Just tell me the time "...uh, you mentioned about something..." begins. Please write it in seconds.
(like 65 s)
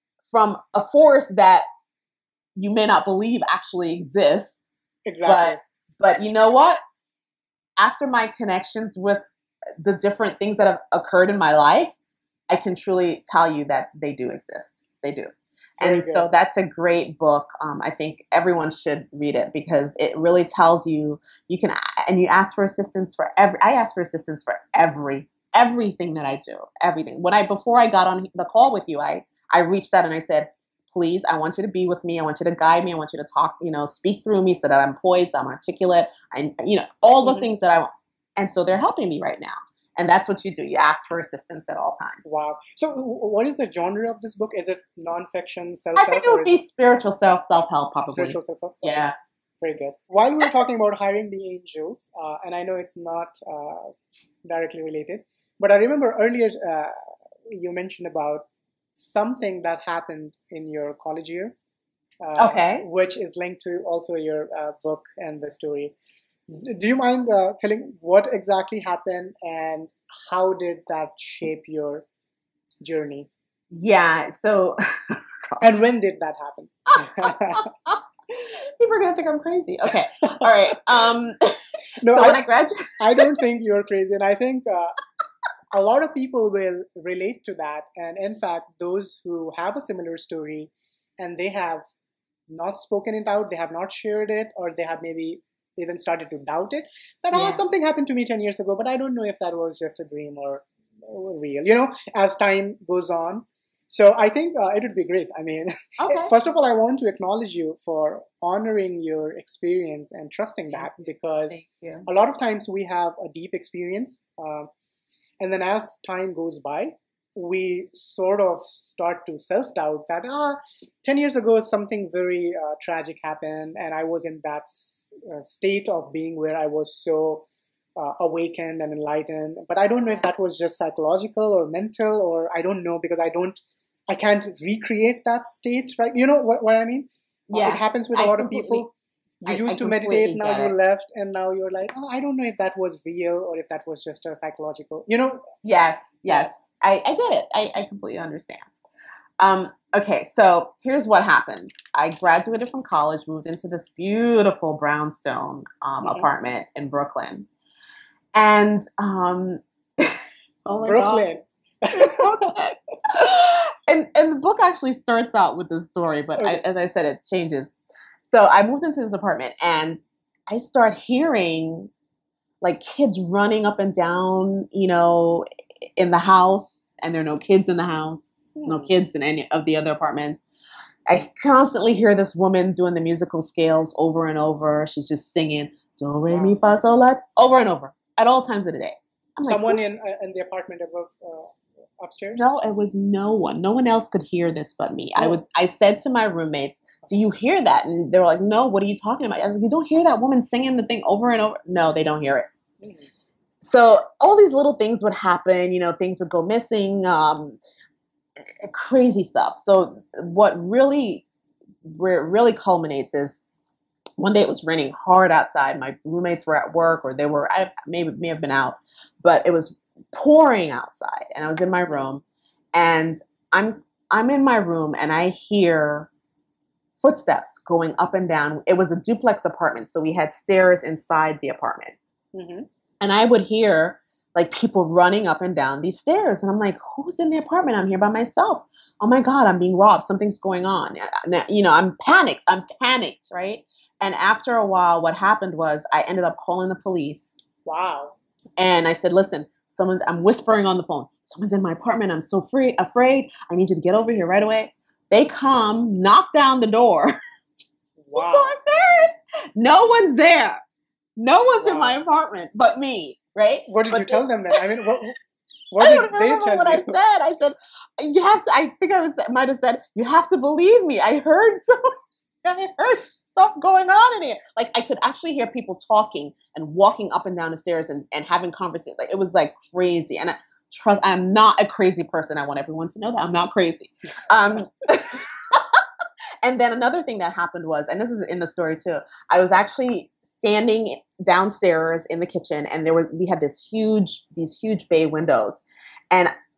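56 s.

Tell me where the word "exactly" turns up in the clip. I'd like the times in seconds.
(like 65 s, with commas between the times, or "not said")
5 s, 68 s.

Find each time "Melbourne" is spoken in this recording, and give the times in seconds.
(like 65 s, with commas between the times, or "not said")
not said.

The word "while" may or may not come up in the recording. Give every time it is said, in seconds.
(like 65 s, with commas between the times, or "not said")
50 s, 244 s.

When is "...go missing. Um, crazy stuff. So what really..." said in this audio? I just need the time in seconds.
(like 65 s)
206 s.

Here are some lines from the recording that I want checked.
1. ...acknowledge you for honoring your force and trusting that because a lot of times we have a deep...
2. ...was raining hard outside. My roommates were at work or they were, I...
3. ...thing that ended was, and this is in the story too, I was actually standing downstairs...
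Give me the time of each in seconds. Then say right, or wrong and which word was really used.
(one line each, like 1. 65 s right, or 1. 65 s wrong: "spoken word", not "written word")
1. 107 s wrong: "experience", not "force"
2. 214 s right
3. 287 s wrong: "happened", not "ended".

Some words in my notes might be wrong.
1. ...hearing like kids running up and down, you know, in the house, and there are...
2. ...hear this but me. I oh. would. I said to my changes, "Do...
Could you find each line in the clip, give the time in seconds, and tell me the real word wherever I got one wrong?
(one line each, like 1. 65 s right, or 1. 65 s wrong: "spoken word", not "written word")
1. 170 s right
2. 194 s wrong: "roommates", not "changes".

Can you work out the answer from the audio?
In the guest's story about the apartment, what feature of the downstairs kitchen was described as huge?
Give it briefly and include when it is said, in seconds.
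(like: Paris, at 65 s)
Bay windows, at 294 s.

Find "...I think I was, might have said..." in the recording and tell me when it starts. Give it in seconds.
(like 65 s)
268 s.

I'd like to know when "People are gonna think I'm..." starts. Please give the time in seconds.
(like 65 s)
78 s.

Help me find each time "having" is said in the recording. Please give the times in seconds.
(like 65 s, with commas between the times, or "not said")
278 s.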